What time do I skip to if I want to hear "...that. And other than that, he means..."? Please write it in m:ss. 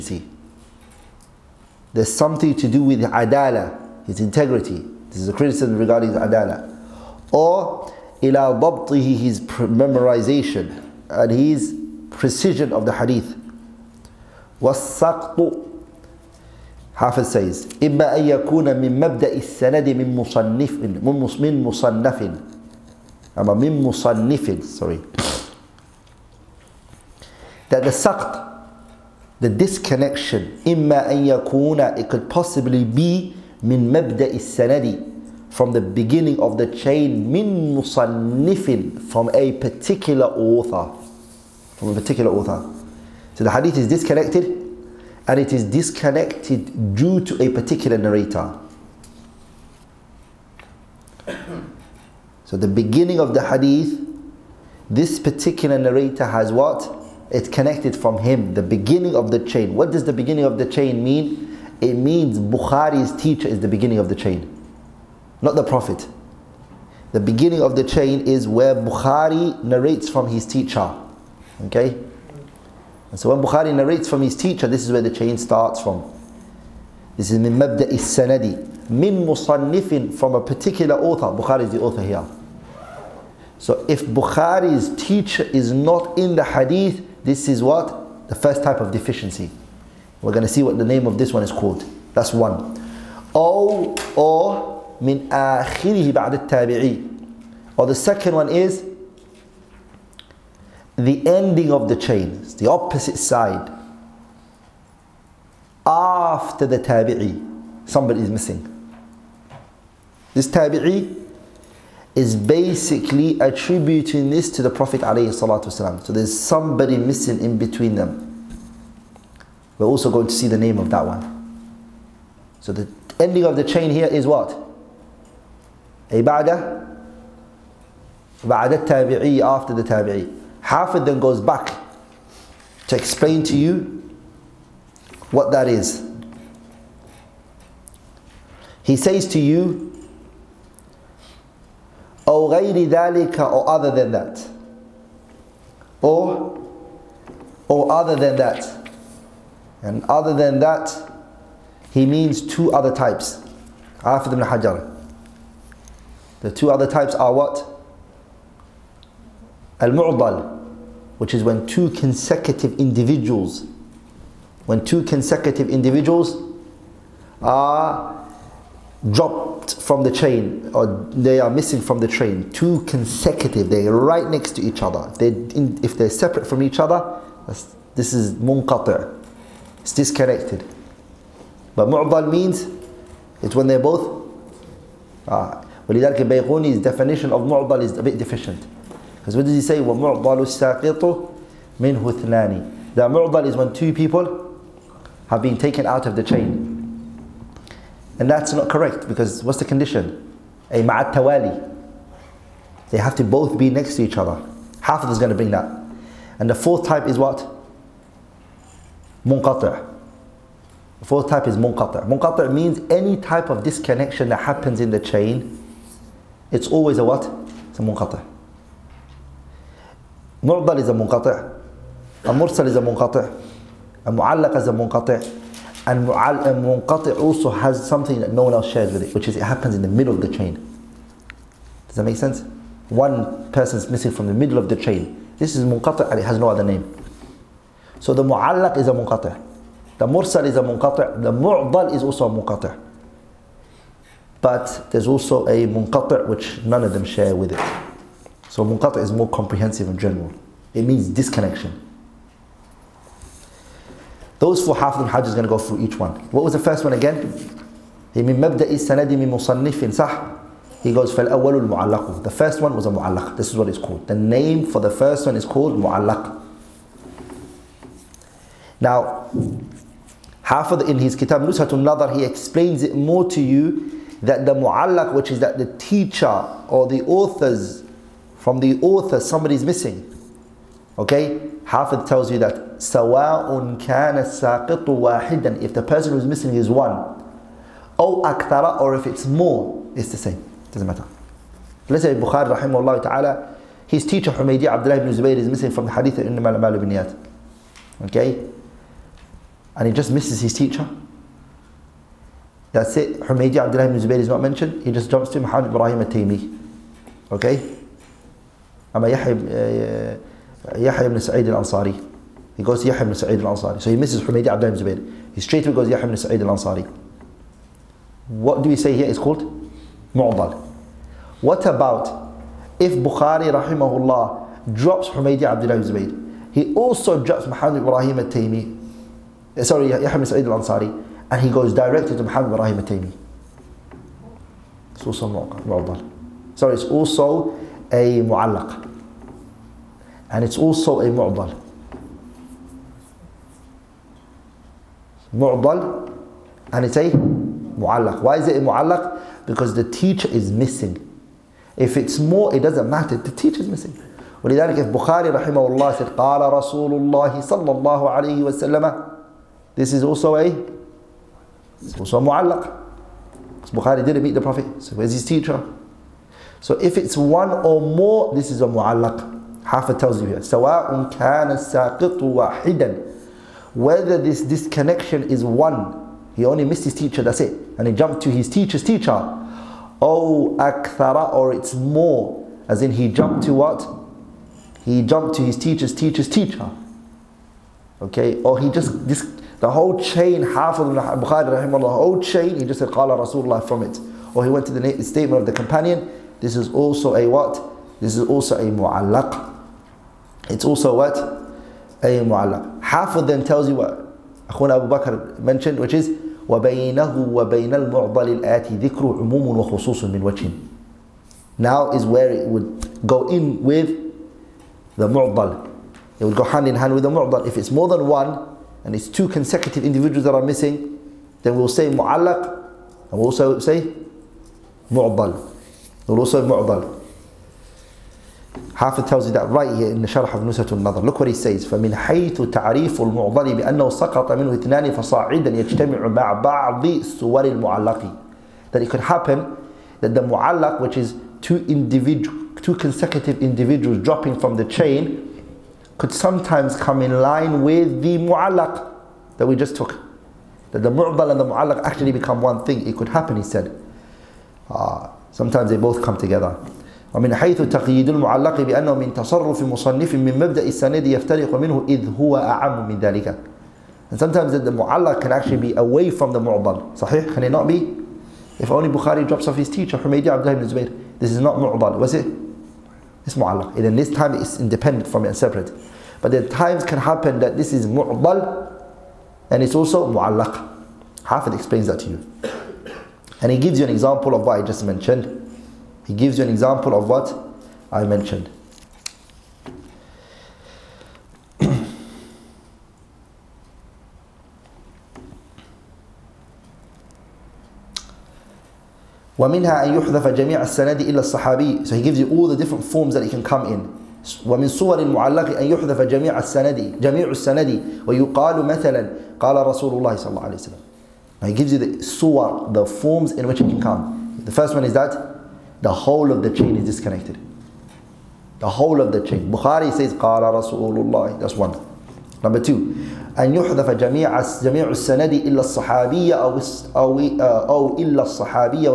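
2:28.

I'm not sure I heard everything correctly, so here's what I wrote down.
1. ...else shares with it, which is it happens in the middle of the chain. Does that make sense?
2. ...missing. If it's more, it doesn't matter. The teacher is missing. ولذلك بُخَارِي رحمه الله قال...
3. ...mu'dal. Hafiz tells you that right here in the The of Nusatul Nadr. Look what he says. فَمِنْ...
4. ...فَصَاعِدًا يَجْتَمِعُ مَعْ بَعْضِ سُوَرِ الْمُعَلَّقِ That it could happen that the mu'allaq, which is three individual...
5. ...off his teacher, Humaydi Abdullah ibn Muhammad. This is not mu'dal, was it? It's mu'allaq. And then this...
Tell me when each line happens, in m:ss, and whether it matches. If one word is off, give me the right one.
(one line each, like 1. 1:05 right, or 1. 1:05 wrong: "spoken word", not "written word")
1. 3:48 right
2. 5:50 right
3. 7:06 wrong: "Sharh", not "The"
4. 7:14 wrong: "two", not "three"
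5. 7:49 wrong: "Zubayr", not "Muhammad".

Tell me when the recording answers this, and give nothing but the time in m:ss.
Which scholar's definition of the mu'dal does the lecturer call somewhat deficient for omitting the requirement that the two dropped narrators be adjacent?
3:06.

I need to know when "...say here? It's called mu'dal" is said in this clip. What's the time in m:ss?
5:18.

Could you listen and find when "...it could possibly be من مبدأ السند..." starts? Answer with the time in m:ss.
0:31.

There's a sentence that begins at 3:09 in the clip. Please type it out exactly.
وَمُعْضَلُ السَّاقِطُ مِنْهُ اثْنَانِ The mu'dal is when two people have been taken out of the chain.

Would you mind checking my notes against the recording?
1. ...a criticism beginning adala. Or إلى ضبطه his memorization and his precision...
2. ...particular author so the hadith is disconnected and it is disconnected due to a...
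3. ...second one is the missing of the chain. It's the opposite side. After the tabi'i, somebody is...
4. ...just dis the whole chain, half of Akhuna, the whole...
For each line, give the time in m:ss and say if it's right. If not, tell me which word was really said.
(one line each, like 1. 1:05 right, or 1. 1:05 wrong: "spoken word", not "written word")
1. 0:05 wrong: "regarding", not "beginning"
2. 0:41 right
3. 1:37 wrong: "ending", not "missing"
4. 6:28 wrong: "Bukhari", not "Akhuna".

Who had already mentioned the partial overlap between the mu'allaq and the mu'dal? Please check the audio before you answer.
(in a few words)
Abu Bakr.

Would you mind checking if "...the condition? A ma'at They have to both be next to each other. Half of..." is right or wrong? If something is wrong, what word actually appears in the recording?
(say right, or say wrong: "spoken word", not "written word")
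right.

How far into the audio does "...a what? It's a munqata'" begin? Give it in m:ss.
3:36.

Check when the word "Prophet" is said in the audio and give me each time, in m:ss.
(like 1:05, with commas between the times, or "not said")
1:05, 1:54, 6:04.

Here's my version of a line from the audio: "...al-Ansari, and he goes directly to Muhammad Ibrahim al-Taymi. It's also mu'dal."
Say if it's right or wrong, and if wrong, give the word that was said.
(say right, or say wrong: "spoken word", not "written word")
right.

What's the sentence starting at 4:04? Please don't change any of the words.
But there's also a munqati' which none of them share with it.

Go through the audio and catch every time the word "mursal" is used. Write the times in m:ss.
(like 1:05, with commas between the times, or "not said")
3:42, 4:00.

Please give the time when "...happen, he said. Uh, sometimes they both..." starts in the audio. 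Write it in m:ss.
7:33.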